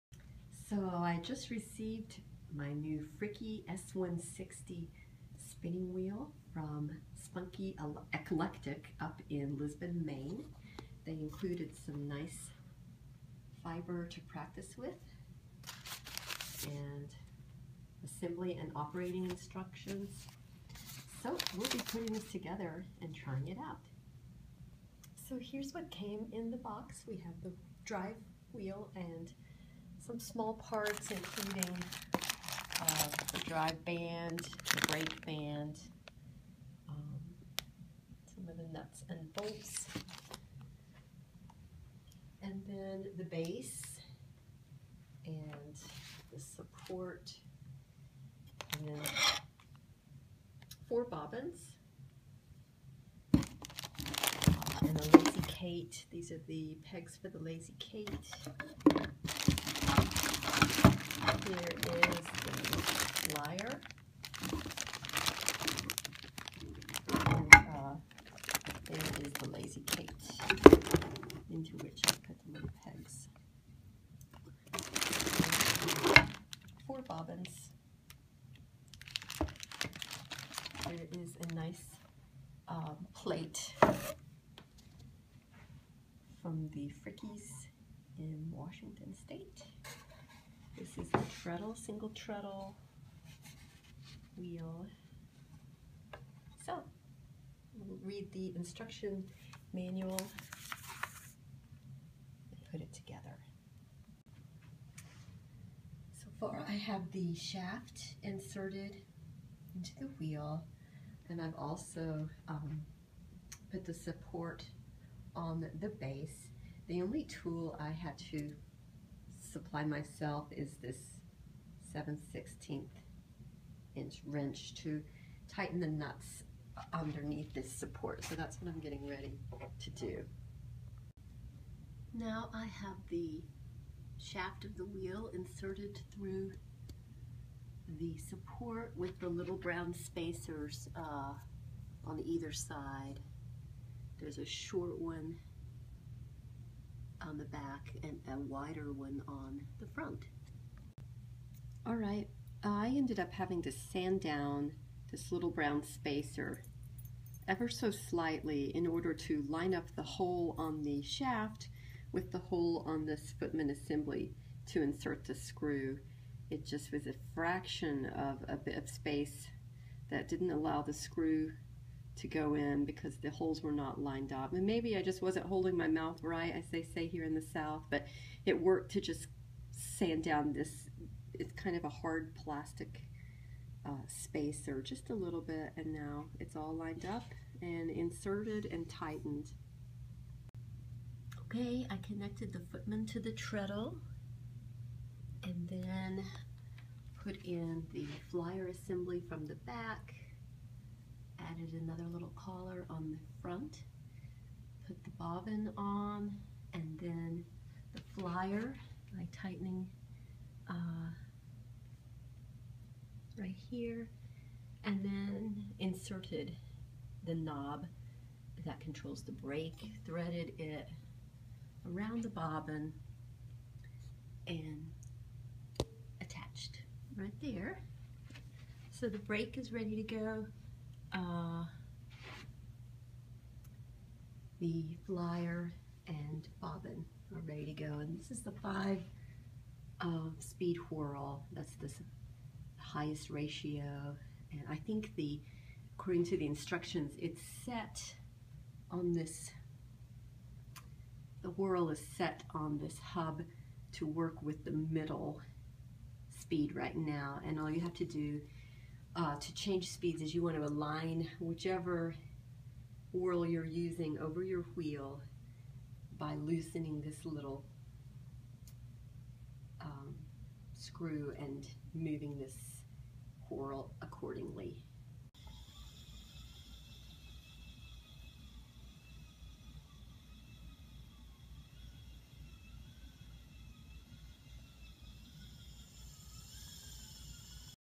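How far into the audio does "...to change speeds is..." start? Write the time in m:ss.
4:19.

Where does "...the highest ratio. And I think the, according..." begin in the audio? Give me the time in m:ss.
4:01.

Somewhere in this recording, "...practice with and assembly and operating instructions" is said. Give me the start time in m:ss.
0:14.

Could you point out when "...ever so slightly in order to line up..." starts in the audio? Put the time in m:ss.
2:37.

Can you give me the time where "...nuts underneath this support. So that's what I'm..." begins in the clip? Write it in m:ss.
2:05.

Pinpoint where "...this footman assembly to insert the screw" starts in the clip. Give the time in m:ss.
2:43.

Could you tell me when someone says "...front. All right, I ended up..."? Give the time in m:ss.
2:29.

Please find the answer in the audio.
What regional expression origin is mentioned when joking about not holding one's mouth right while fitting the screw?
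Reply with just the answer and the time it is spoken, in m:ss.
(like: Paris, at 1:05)
the South, at 2:57.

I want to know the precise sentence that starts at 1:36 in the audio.
So, we'll read the instruction manual and put it together.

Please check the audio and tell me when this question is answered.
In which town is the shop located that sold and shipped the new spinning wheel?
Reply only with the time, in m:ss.
0:09.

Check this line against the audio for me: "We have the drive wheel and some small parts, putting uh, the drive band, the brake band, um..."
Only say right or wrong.
wrong.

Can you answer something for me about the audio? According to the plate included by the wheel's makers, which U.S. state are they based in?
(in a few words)
Washington State.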